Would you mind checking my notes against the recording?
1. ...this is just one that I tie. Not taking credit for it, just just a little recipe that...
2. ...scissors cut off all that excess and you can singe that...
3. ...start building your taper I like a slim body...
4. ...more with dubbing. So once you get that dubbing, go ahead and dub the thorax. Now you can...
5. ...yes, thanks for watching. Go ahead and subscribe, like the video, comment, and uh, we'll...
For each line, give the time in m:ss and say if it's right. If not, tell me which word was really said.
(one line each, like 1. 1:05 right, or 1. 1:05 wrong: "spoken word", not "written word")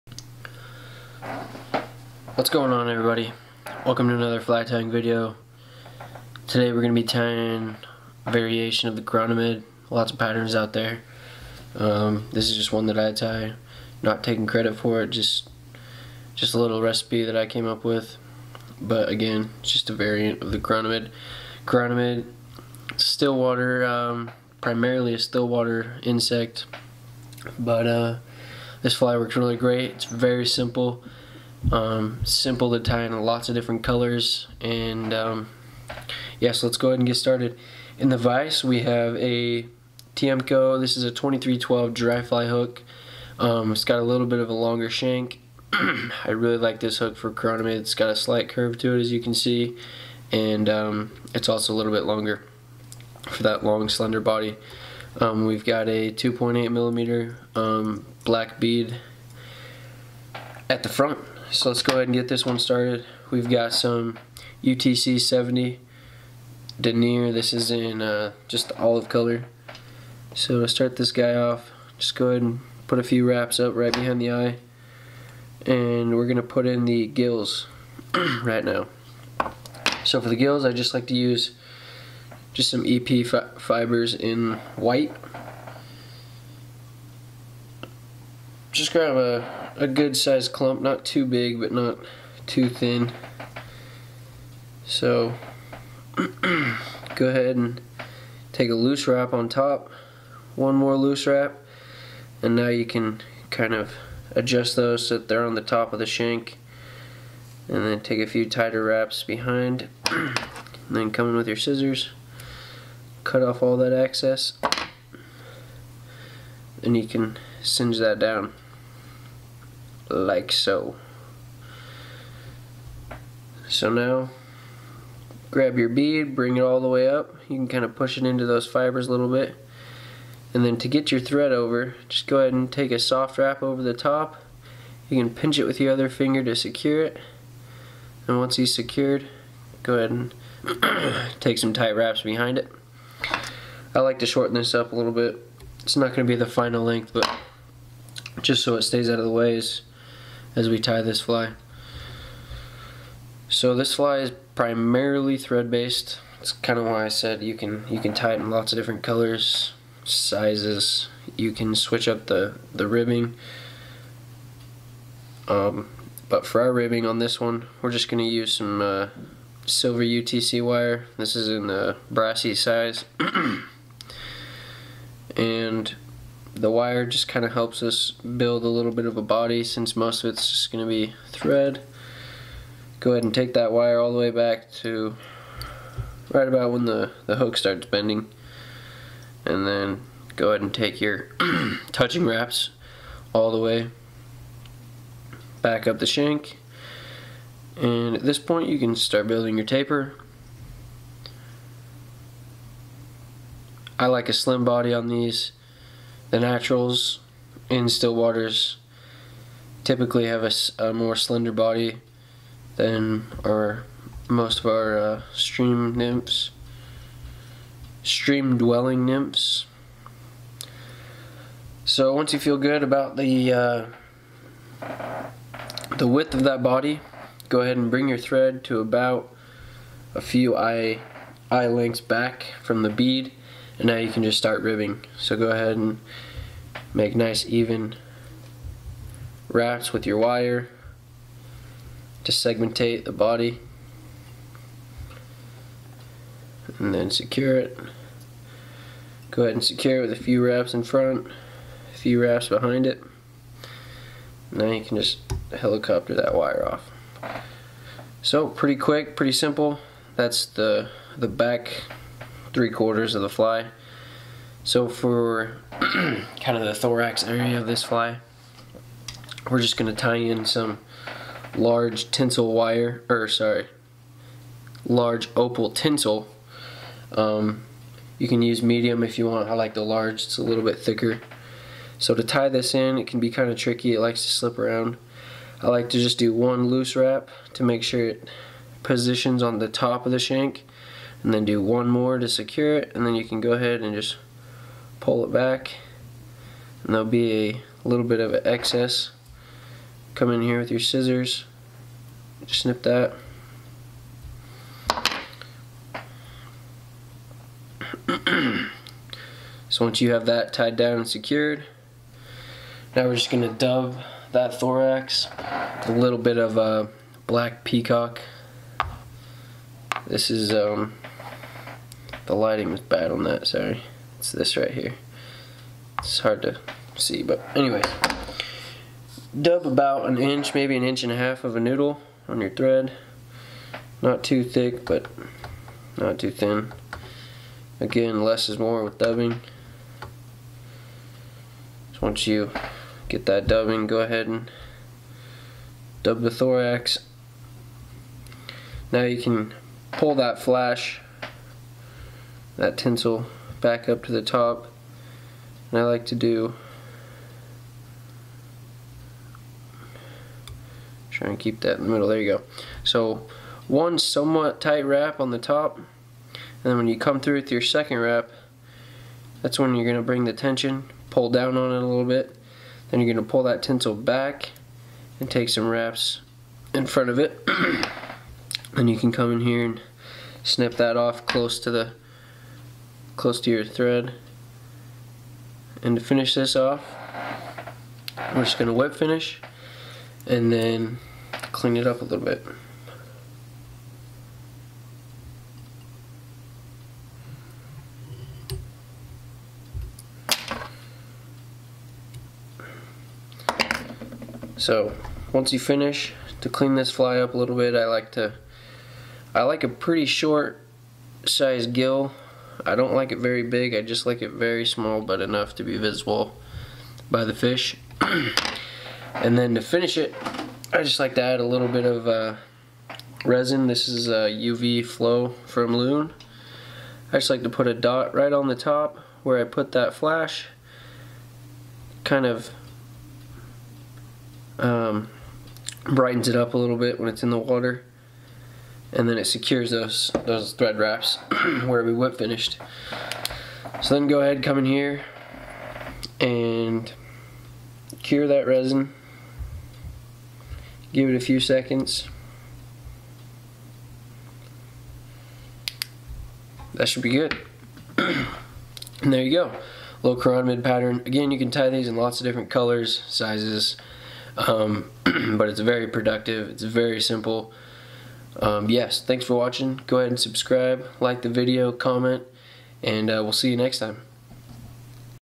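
1. 0:12 right
2. 1:51 right
3. 3:18 right
4. 5:38 right
5. 7:48 right.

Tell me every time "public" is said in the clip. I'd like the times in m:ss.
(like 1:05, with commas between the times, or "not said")
not said.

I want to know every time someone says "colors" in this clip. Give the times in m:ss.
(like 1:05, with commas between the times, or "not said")
0:33, 1:09, 2:39, 7:42.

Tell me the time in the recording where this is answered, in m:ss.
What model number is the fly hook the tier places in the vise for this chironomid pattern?
0:41.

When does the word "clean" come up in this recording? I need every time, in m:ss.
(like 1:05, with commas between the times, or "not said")
6:31, 6:46.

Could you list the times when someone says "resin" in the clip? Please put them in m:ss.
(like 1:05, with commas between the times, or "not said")
7:03, 7:28.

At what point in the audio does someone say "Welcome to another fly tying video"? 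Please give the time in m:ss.
0:03.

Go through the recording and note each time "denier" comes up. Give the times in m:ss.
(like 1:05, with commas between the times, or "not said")
1:06.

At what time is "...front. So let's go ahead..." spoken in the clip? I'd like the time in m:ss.
1:00.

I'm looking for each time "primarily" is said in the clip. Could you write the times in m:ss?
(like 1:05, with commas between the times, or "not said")
0:24, 2:34.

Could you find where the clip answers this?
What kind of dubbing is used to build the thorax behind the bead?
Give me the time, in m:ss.
5:17.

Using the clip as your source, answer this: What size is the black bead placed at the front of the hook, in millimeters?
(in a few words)
2.8 millimeter.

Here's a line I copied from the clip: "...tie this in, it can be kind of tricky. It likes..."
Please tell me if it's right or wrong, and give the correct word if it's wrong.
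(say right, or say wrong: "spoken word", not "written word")
right.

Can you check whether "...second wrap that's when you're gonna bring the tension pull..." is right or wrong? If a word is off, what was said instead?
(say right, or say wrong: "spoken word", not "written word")
right.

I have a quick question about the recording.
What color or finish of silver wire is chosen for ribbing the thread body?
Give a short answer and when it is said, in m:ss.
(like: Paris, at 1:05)
brassy, at 2:52.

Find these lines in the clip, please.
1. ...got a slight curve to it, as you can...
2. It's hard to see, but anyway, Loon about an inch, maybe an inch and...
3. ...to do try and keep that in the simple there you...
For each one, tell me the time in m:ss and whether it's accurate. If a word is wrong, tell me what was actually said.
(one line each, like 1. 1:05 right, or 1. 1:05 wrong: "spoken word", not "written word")
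1. 0:47 right
2. 5:25 wrong: "Dub", not "Loon"
3. 5:56 wrong: "middle", not "simple".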